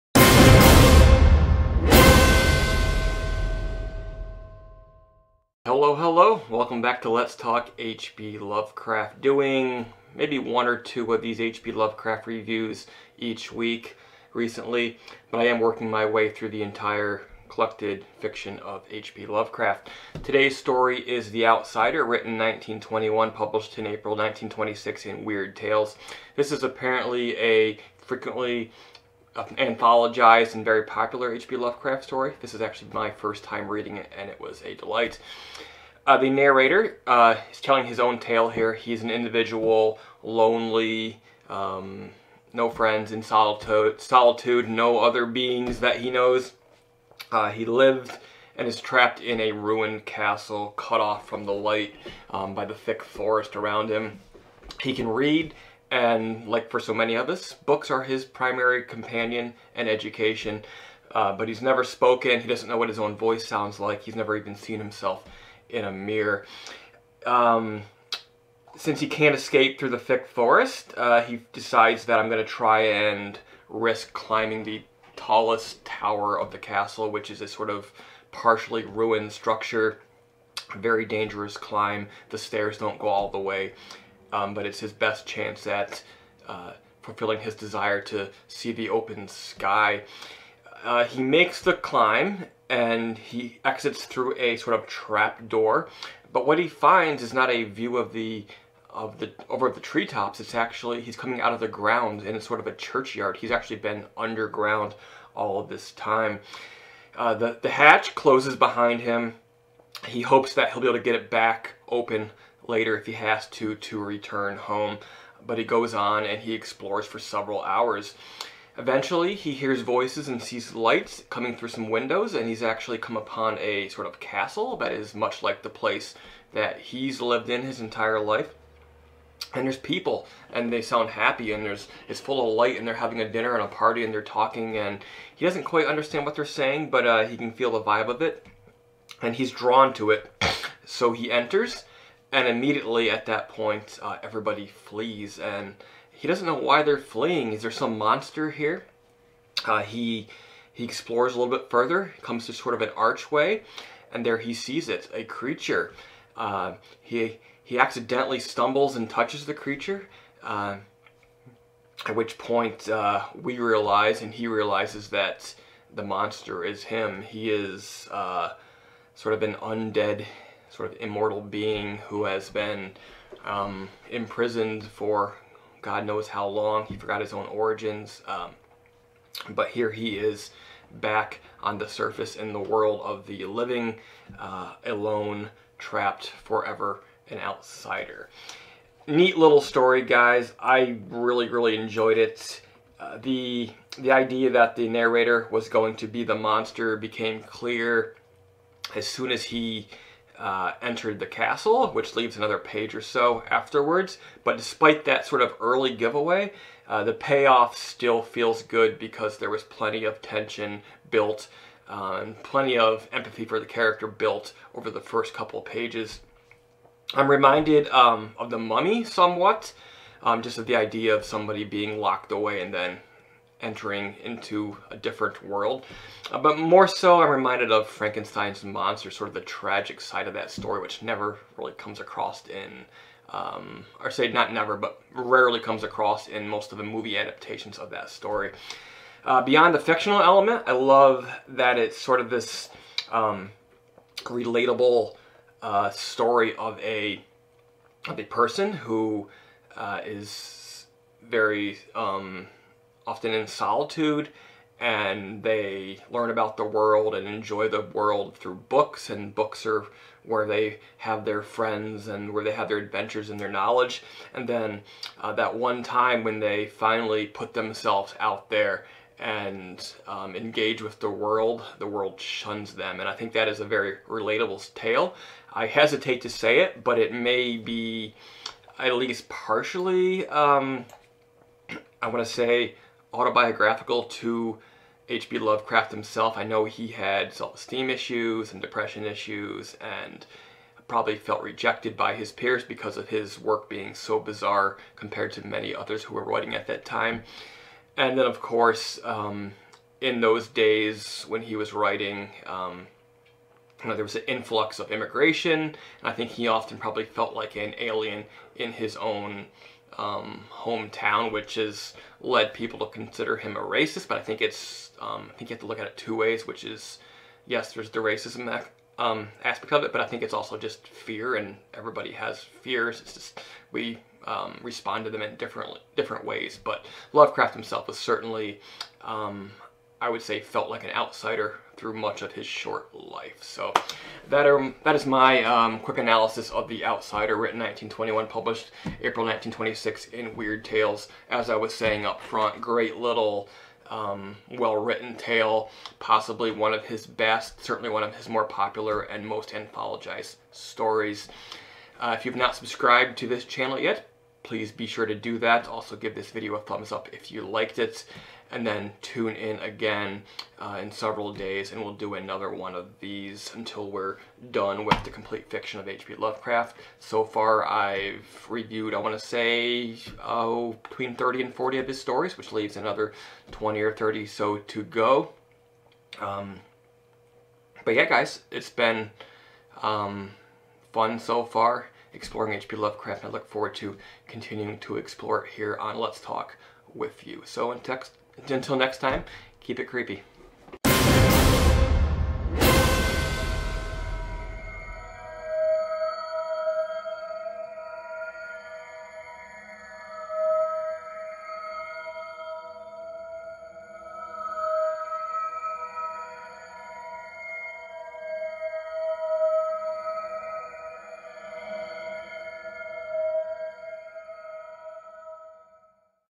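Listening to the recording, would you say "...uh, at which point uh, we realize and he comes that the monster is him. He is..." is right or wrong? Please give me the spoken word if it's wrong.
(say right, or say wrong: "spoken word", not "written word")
wrong: "realizes", not "comes".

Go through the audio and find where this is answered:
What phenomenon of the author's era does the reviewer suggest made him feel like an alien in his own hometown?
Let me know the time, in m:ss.
5:04.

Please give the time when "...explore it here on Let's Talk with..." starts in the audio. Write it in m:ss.
6:24.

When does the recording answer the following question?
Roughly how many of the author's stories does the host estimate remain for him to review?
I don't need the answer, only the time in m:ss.
6:13.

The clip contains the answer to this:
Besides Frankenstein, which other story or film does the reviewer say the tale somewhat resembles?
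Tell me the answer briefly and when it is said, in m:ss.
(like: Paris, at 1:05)
The Mummy, at 3:38.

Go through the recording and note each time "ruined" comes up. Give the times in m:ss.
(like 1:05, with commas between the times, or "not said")
0:49, 1:18.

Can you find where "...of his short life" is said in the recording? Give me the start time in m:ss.
5:32.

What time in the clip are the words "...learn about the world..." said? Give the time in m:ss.
4:16.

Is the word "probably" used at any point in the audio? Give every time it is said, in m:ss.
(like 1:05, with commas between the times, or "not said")
4:50, 5:06.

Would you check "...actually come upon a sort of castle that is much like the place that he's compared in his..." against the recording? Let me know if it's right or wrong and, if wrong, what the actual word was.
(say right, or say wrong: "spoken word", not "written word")
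wrong: "lived", not "compared".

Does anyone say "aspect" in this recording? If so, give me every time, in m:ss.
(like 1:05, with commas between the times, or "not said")
5:19.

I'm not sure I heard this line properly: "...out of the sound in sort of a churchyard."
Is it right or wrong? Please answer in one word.
wrong.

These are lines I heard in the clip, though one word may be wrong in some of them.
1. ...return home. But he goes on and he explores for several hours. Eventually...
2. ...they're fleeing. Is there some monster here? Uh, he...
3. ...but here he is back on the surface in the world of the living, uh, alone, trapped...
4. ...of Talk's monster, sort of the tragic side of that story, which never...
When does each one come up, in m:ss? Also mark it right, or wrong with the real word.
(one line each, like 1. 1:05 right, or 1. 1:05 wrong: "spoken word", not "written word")
1. 1:54 right
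2. 2:26 right
3. 2:59 right
4. 3:47 wrong: "Frankenstein", not "Talk".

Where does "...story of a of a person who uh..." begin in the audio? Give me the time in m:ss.
4:05.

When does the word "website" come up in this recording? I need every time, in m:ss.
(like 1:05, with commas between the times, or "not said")
not said.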